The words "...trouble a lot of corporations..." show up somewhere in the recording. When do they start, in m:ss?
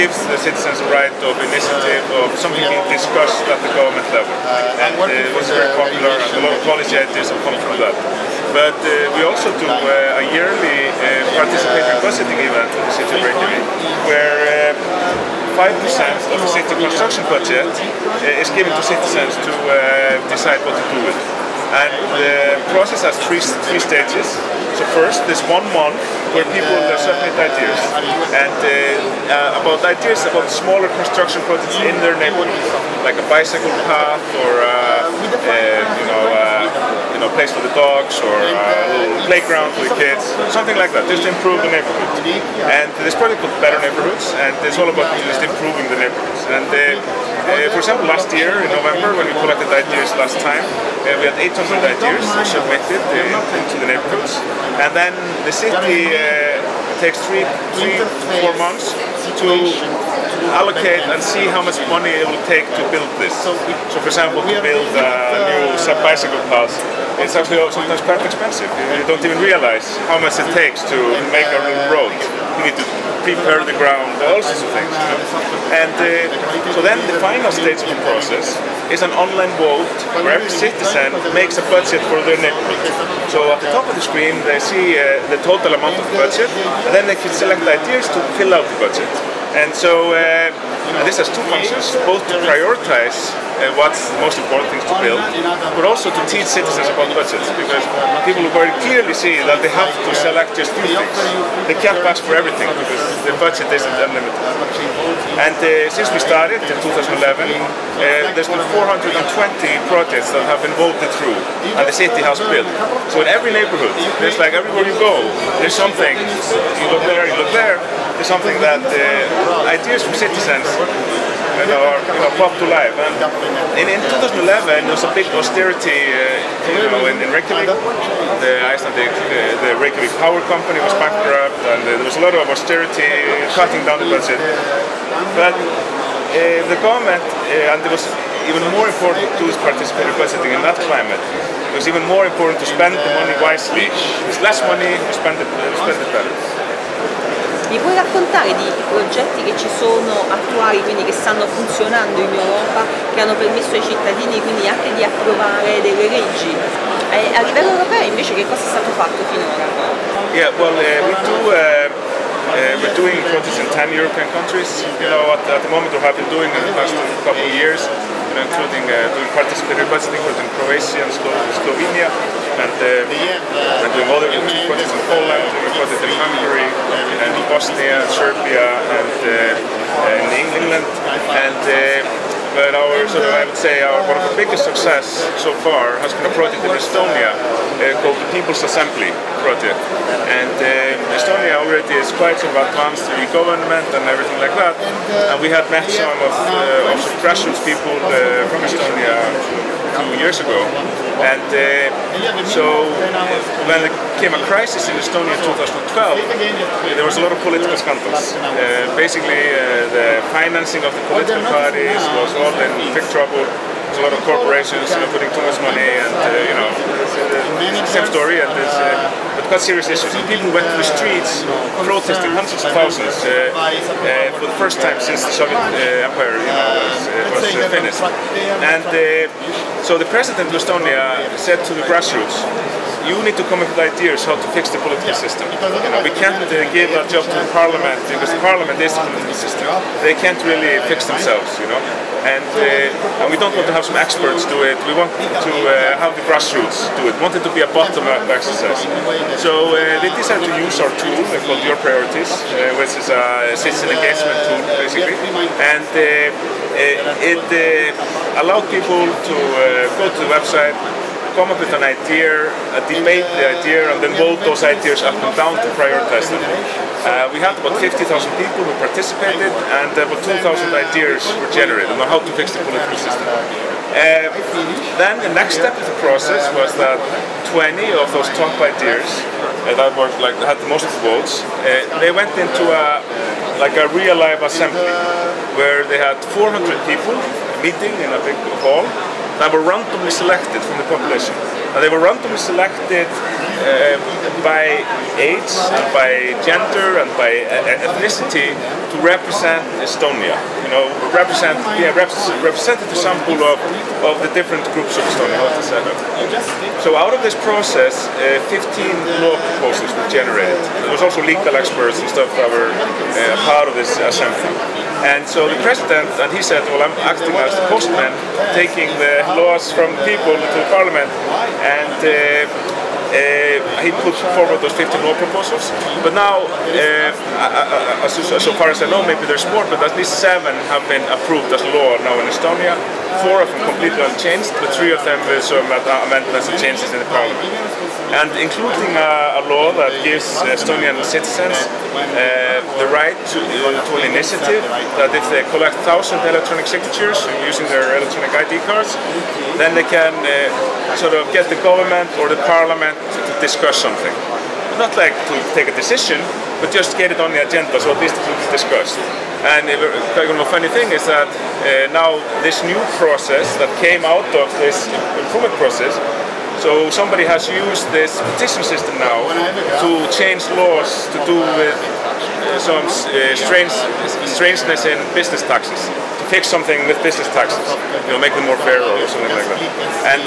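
3:33.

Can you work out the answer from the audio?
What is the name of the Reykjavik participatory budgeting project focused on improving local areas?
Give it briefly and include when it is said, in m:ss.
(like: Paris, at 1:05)
Better Neighborhoods, at 0:43.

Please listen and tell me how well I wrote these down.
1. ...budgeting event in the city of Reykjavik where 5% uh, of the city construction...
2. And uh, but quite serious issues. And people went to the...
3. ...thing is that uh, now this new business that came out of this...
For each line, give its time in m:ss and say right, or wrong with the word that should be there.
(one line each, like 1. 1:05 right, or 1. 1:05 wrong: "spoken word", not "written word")
1. 0:12 right
2. 3:38 right
3. 6:00 wrong: "process", not "business".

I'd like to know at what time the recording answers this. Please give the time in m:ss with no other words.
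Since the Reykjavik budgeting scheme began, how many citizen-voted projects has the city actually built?
1:48.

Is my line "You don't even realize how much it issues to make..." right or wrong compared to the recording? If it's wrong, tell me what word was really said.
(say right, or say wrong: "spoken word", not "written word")
wrong: "takes", not "issues".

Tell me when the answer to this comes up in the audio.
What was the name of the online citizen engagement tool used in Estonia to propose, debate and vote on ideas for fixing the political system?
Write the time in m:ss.
4:11.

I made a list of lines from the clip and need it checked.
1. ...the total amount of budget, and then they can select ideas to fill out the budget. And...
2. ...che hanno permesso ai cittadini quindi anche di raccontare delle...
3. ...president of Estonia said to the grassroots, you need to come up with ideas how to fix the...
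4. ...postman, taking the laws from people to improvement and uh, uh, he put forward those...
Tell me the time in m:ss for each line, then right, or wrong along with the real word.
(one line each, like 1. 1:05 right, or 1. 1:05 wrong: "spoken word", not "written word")
1. 1:25 right
2. 2:32 wrong: "approvare", not "raccontare"
3. 3:50 right
4. 5:17 wrong: "parliament", not "improvement".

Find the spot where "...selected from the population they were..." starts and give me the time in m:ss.
4:50.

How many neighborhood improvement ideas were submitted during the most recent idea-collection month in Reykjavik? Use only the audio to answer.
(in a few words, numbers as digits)
800.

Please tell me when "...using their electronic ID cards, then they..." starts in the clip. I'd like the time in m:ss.
5:47.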